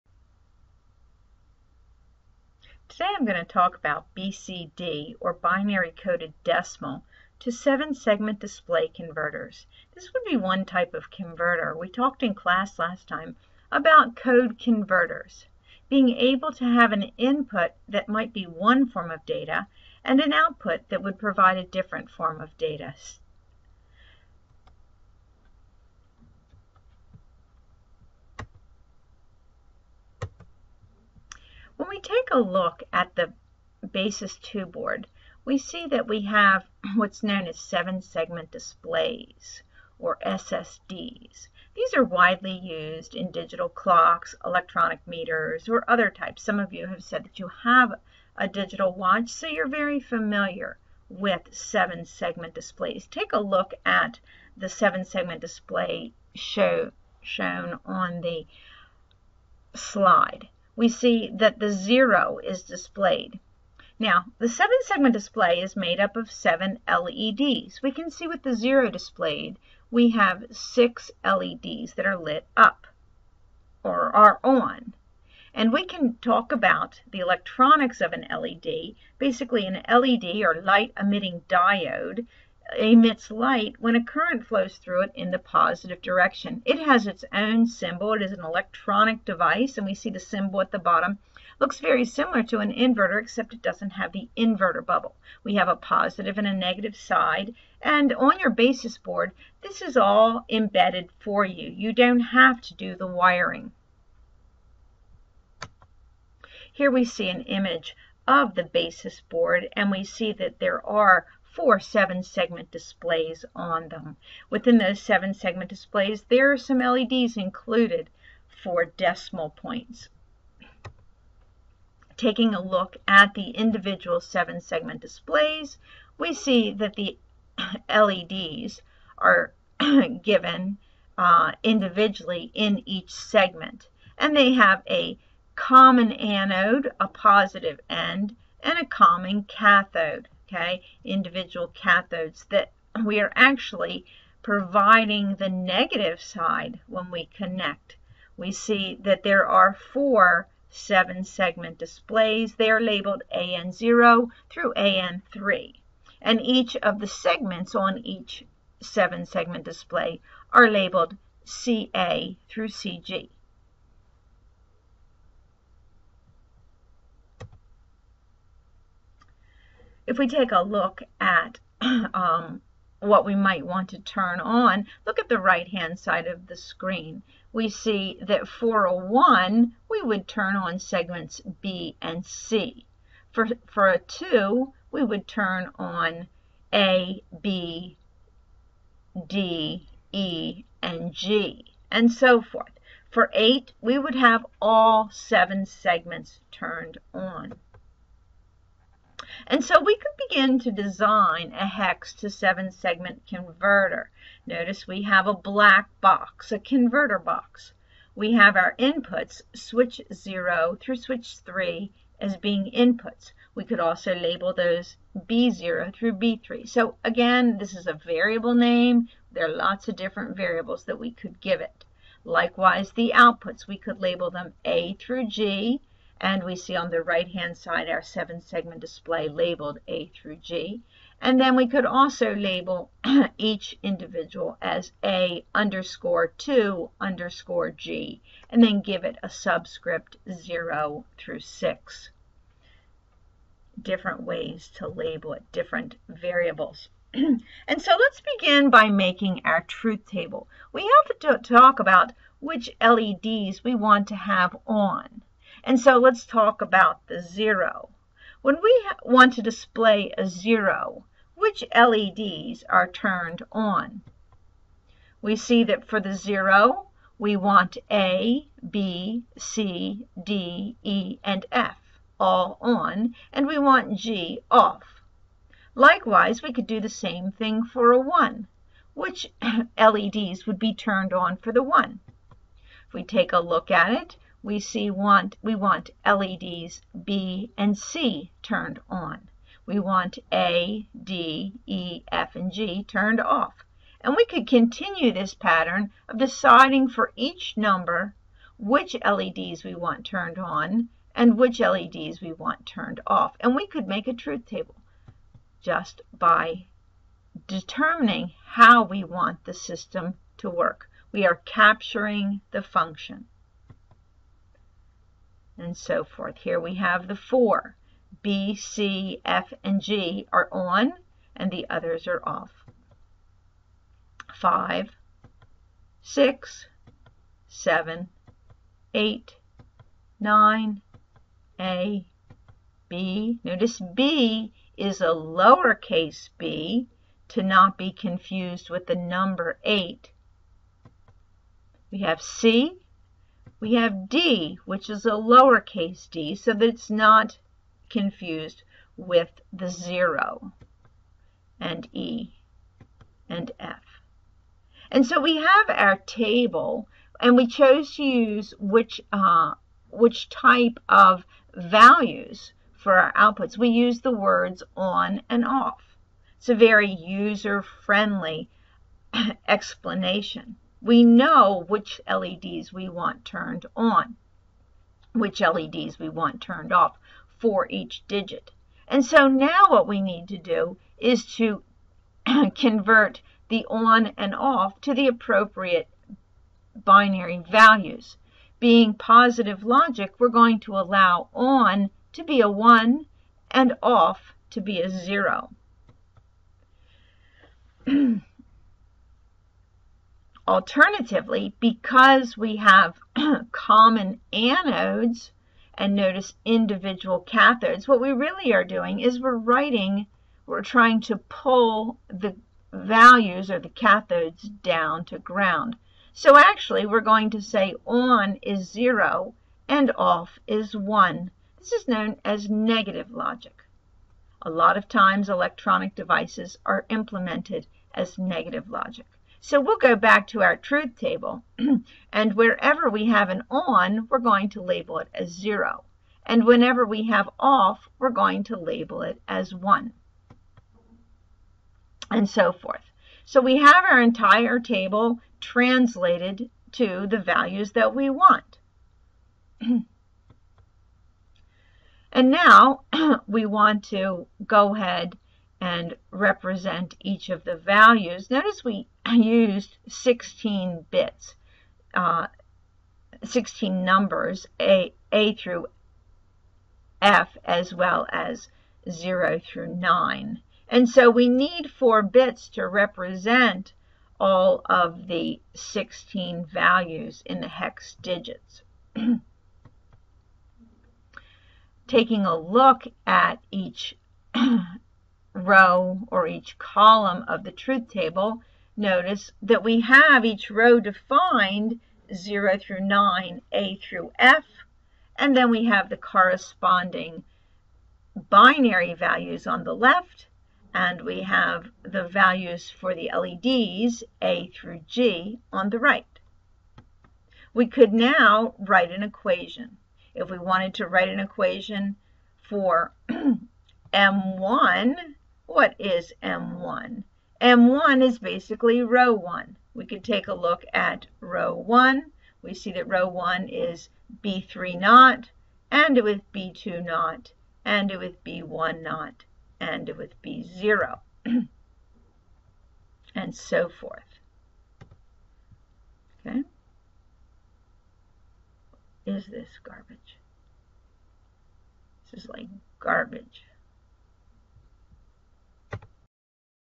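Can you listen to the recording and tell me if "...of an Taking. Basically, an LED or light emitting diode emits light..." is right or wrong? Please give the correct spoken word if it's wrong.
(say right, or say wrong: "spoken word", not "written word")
wrong: "LED", not "Taking".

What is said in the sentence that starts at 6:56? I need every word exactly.
So actually, we're going to say on is 0 and off is 1.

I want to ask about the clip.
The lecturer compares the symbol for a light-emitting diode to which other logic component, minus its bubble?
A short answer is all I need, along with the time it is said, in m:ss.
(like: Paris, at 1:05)
an inverter, at 1:32.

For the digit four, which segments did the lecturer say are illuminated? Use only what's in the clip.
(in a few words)
B, C, F, and G.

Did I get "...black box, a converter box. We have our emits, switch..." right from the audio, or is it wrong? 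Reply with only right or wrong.
wrong.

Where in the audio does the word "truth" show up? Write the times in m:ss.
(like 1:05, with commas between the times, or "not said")
4:09, 5:04, 7:10, 8:07.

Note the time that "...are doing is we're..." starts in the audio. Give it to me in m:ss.
6:48.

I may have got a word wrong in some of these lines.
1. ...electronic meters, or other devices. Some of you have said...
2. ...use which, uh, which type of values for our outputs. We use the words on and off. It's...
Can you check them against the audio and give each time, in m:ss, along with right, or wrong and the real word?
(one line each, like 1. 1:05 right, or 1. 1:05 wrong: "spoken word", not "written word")
1. 0:44 wrong: "types", not "devices"
2. 5:58 right.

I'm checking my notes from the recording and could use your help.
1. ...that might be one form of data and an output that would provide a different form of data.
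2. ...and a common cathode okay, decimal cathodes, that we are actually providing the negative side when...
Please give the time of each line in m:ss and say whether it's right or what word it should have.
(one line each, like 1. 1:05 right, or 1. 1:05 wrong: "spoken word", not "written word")
1. 0:17 right
2. 2:18 wrong: "individual", not "decimal".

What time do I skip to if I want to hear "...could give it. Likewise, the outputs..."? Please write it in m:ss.
3:41.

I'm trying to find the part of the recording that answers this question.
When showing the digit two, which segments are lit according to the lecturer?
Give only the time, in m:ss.
3:06.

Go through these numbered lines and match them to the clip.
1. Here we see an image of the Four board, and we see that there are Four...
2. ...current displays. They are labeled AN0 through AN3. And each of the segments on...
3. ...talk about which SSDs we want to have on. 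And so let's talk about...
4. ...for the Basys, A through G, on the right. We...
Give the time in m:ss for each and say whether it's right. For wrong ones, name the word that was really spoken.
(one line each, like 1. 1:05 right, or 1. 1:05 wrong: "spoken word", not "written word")
1. 1:46 wrong: "Basys", not "Four"
2. 2:31 wrong: "segment", not "current"
3. 4:11 wrong: "LEDs", not "SSDs"
4. 8:22 wrong: "LEDs", not "Basys".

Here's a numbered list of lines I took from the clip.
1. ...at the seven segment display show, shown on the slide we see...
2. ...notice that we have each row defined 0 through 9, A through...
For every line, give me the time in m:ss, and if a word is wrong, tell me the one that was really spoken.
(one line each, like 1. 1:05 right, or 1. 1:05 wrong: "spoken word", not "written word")
1. 0:53 right
2. 8:08 right.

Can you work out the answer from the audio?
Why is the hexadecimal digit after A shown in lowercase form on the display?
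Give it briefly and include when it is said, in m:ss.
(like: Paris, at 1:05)
to not be confused with 8, at 5:37.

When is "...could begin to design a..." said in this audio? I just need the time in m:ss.
3:19.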